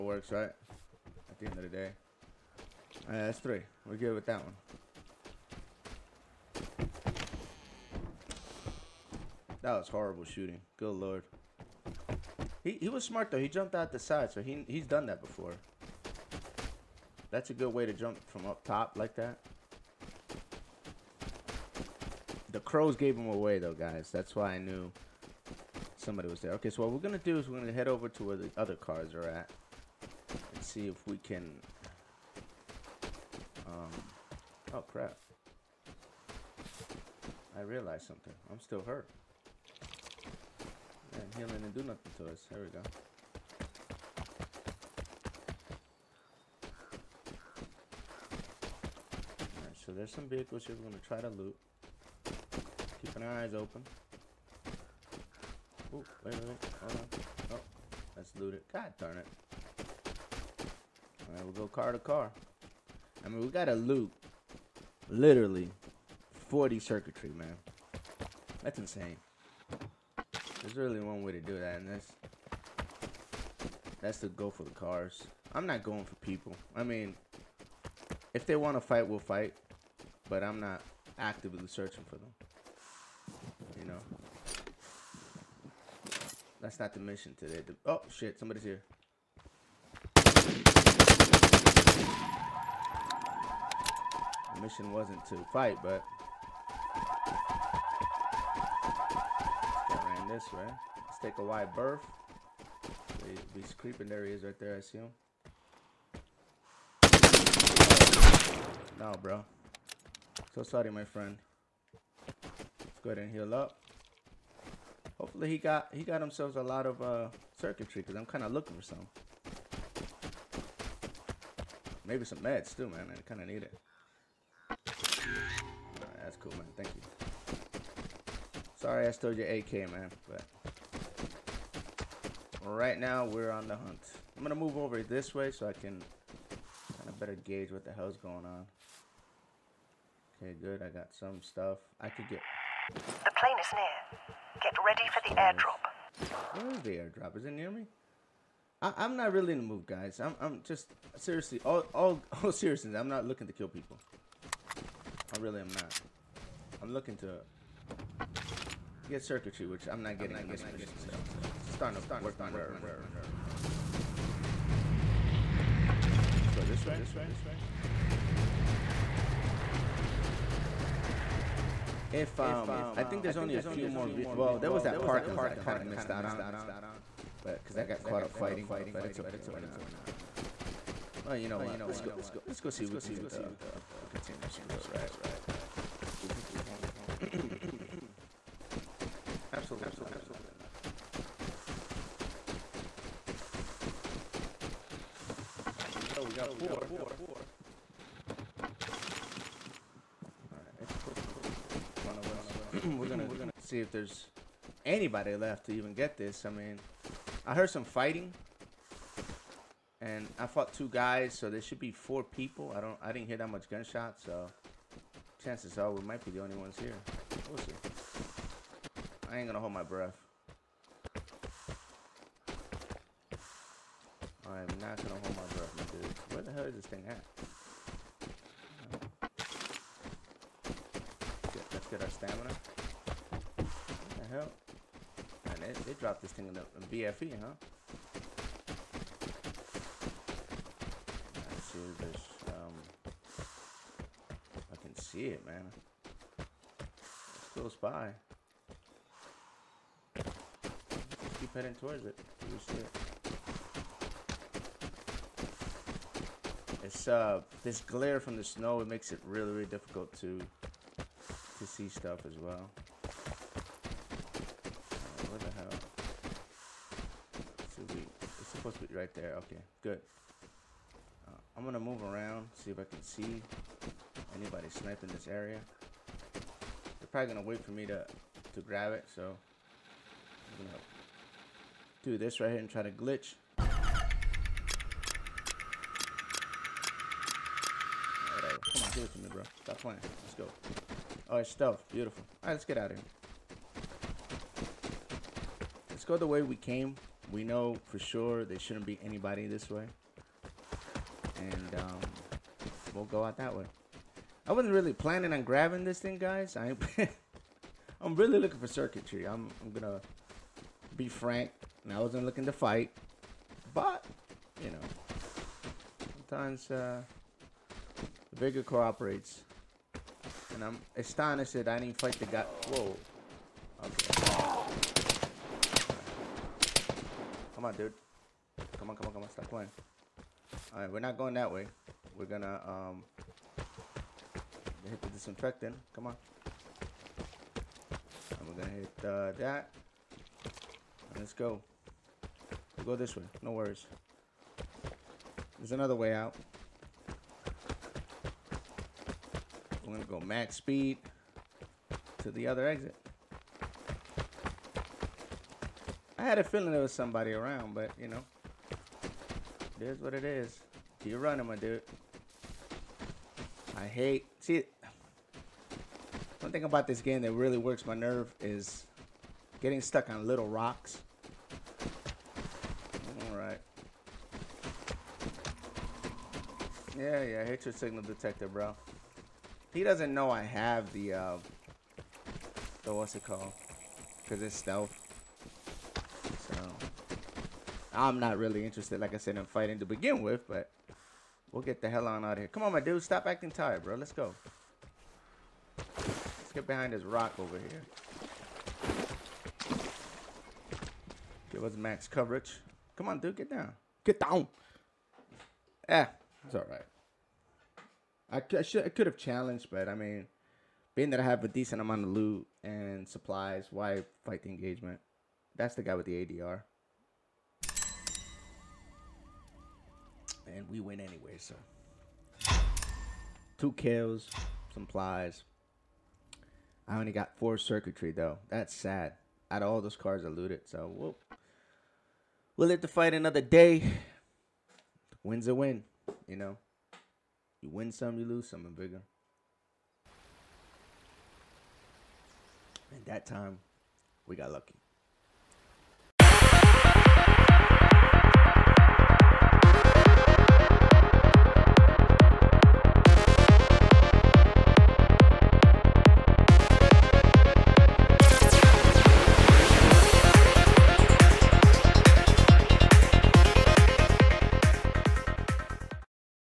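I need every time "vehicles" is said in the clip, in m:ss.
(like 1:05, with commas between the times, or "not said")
0:50.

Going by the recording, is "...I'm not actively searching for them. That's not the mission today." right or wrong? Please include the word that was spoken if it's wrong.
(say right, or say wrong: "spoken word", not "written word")
right.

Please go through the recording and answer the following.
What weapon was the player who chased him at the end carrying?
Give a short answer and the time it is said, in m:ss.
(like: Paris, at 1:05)
ADR, at 6:56.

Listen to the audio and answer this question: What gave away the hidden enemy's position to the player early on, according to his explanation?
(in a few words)
The crows.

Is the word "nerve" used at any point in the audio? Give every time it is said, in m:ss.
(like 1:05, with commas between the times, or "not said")
2:42, 6:07.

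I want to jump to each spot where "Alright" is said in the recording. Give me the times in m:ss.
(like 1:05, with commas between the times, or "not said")
0:03, 0:49, 1:01.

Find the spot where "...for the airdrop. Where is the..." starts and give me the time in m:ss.
2:25.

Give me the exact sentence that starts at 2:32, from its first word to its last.
I'm not looking to kill people.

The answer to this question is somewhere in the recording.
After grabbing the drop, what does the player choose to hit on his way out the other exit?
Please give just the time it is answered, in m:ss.
5:34.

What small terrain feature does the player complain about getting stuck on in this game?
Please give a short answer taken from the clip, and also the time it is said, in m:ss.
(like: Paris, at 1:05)
Little rocks, at 6:10.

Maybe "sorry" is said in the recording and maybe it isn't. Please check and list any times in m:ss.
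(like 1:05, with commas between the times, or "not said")
1:50, 2:08.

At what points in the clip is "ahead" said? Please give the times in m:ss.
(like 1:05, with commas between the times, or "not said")
1:53.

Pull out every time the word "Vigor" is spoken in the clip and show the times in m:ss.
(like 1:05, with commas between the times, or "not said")
5:18, 7:18.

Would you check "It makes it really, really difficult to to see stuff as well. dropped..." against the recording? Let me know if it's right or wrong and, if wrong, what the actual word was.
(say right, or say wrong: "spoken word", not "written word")
wrong: "supposed", not "dropped".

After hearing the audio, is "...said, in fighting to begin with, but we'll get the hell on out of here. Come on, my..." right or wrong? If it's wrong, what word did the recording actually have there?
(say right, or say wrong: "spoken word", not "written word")
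right.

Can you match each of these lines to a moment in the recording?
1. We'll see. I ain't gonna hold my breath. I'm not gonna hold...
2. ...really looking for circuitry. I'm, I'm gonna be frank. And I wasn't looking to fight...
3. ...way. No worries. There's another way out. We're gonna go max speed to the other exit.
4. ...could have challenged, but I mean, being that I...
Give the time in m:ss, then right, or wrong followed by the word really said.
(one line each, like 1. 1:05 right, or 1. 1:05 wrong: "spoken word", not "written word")
1. 3:37 right
2. 5:08 right
3. 5:43 right
4. 6:48 right.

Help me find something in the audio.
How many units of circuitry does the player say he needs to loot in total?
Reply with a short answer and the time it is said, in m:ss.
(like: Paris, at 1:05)
40, at 1:06.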